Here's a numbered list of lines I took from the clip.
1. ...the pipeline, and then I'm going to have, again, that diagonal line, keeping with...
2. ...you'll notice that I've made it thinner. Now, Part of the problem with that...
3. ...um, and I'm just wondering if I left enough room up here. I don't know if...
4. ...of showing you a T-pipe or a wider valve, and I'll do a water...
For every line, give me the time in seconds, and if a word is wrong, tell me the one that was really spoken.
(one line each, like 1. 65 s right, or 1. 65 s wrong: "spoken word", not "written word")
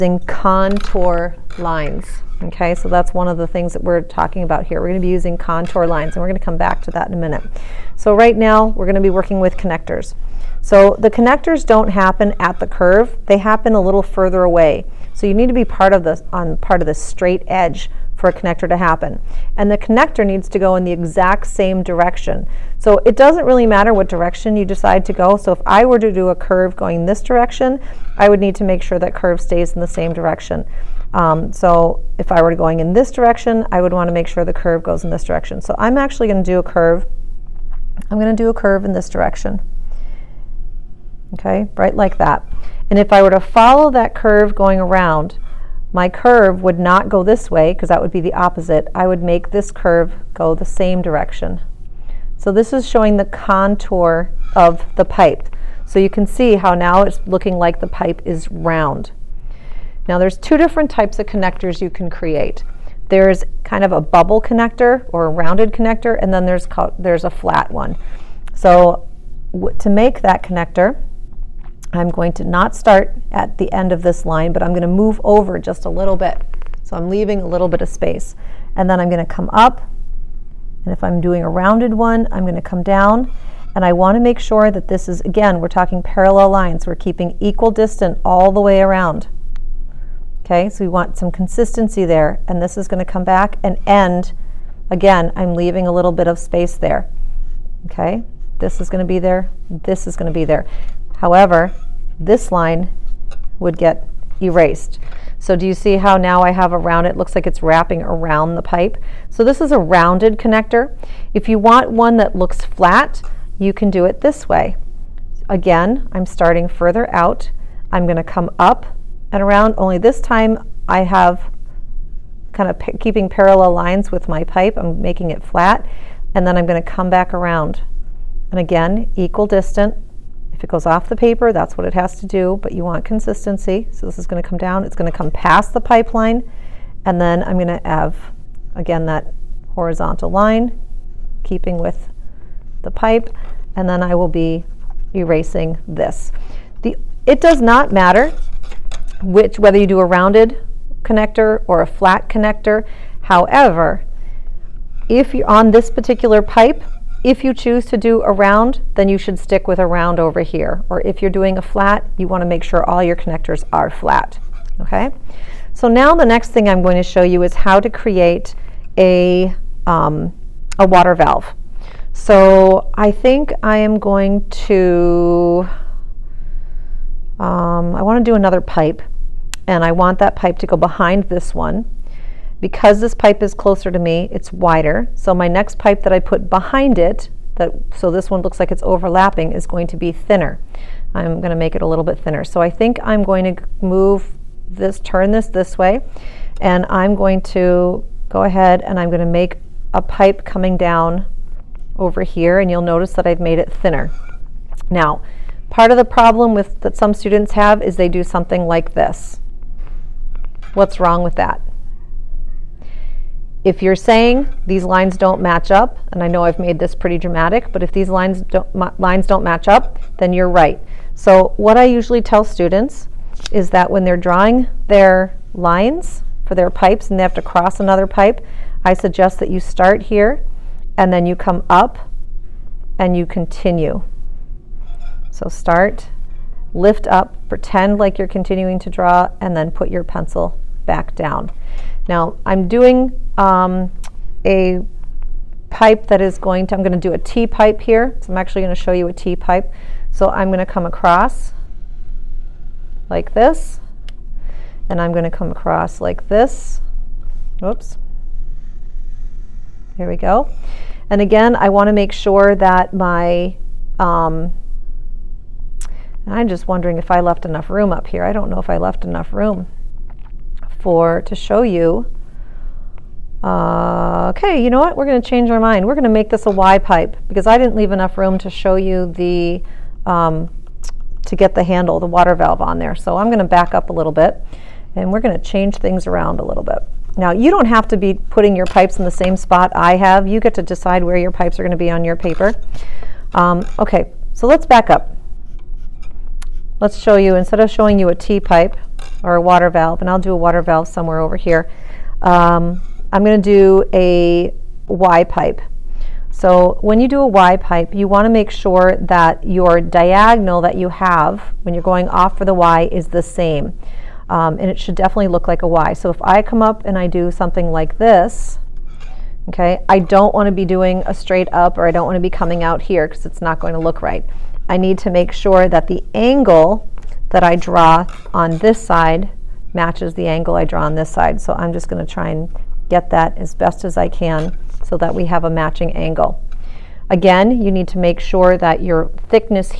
1. 135 s wrong: "horizontal", not "diagonal"
2. 202 s right
3. 263 s right
4. 297 s wrong: "water", not "wider".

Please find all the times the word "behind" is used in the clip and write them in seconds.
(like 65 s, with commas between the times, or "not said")
180 s, 186 s.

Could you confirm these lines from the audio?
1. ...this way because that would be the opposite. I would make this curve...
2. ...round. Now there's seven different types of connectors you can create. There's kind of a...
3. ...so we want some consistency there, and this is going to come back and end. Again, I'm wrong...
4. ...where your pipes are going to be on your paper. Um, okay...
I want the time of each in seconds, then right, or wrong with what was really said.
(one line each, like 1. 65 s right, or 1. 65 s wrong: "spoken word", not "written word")
1. 47 s right
2. 58 s wrong: "two", not "seven"
3. 90 s wrong: "leaving", not "wrong"
4. 291 s right.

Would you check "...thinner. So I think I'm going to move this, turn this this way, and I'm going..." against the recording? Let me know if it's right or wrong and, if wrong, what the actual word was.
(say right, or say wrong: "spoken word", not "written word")
right.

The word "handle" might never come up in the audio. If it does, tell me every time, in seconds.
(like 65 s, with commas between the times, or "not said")
281 s.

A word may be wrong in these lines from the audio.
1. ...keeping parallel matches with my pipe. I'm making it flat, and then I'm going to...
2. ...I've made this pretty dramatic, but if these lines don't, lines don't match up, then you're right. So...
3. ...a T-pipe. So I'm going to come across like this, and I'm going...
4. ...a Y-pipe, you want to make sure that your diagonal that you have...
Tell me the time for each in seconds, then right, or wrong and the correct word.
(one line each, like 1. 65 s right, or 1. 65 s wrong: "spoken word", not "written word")
1. 122 s wrong: "lines", not "matches"
2. 216 s right
3. 249 s right
4. 307 s right.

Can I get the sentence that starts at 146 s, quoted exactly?
The, it does not matter which whether you do a rounded connector or a flat connector.